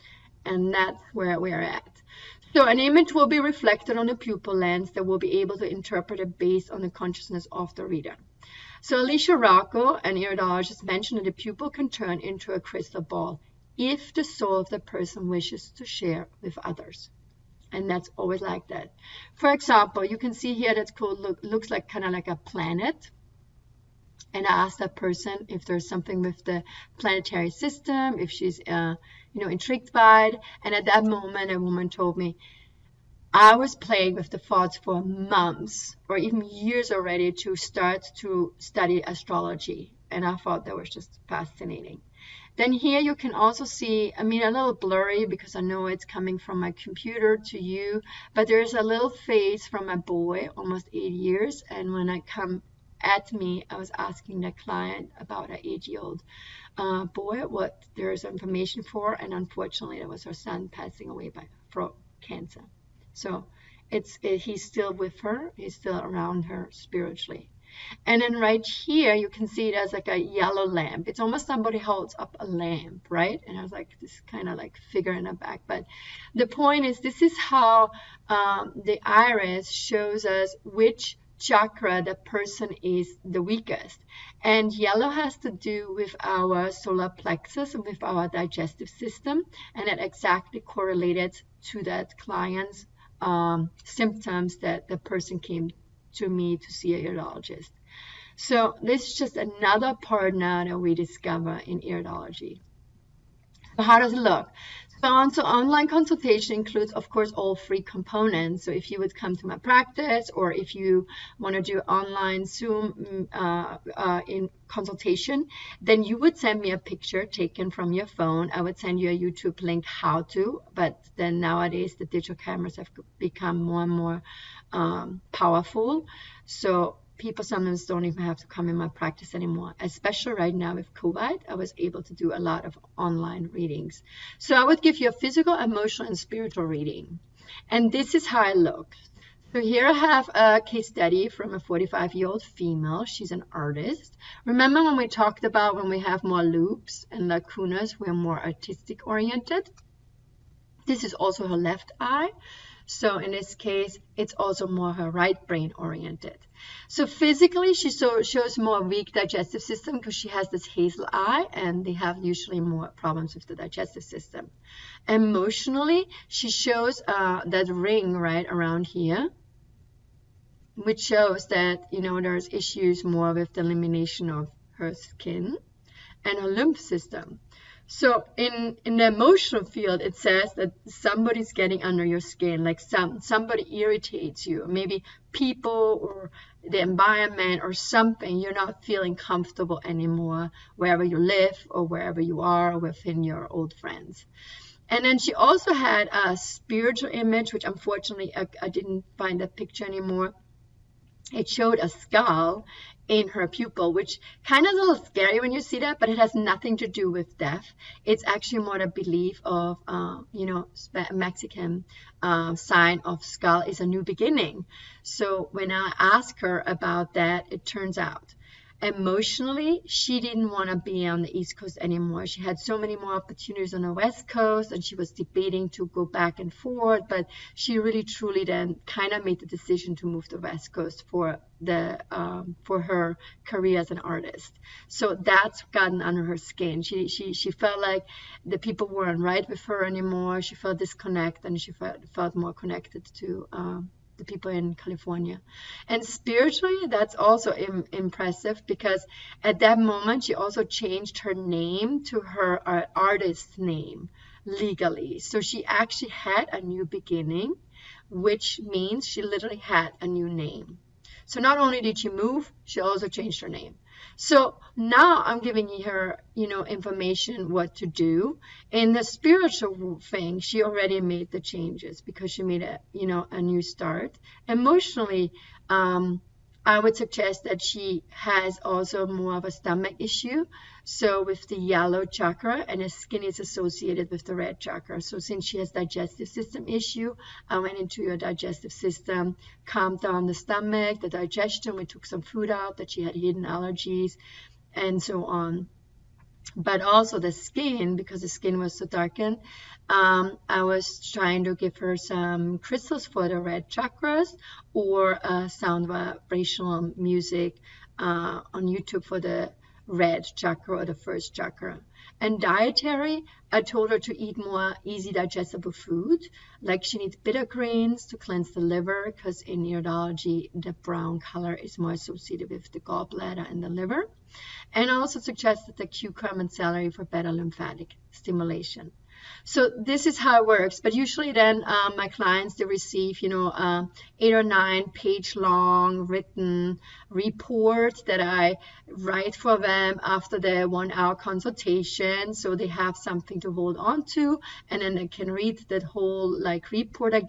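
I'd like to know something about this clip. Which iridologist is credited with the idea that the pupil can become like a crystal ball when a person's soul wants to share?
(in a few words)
Alicia Rocco.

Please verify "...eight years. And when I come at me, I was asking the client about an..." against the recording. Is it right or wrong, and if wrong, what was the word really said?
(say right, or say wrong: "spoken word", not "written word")
right.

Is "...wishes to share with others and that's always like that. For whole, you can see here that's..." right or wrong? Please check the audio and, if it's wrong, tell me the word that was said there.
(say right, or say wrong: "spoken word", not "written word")
wrong: "example", not "whole".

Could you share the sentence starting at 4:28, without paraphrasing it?
In the spiritual thing, she already made the changes because she made a, you know, a new start.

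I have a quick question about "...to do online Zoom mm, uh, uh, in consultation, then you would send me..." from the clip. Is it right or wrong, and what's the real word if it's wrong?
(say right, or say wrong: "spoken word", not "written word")
right.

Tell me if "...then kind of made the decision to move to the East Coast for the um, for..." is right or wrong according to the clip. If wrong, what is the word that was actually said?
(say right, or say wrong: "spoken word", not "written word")
wrong: "West", not "East".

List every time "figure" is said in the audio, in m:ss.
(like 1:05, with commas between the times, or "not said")
1:14.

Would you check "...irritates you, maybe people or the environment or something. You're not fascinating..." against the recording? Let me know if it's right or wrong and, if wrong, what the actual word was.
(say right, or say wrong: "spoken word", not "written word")
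wrong: "feeling", not "fascinating".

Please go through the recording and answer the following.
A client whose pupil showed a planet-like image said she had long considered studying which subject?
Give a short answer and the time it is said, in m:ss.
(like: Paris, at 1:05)
astrology, at 0:39.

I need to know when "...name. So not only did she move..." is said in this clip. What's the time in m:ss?
4:20.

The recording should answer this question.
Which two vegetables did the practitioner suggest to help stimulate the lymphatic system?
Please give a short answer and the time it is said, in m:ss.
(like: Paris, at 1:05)
cucumber and celery, at 5:25.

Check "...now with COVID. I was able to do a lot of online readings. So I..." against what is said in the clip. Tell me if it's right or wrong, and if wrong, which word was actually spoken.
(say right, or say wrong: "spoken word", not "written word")
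right.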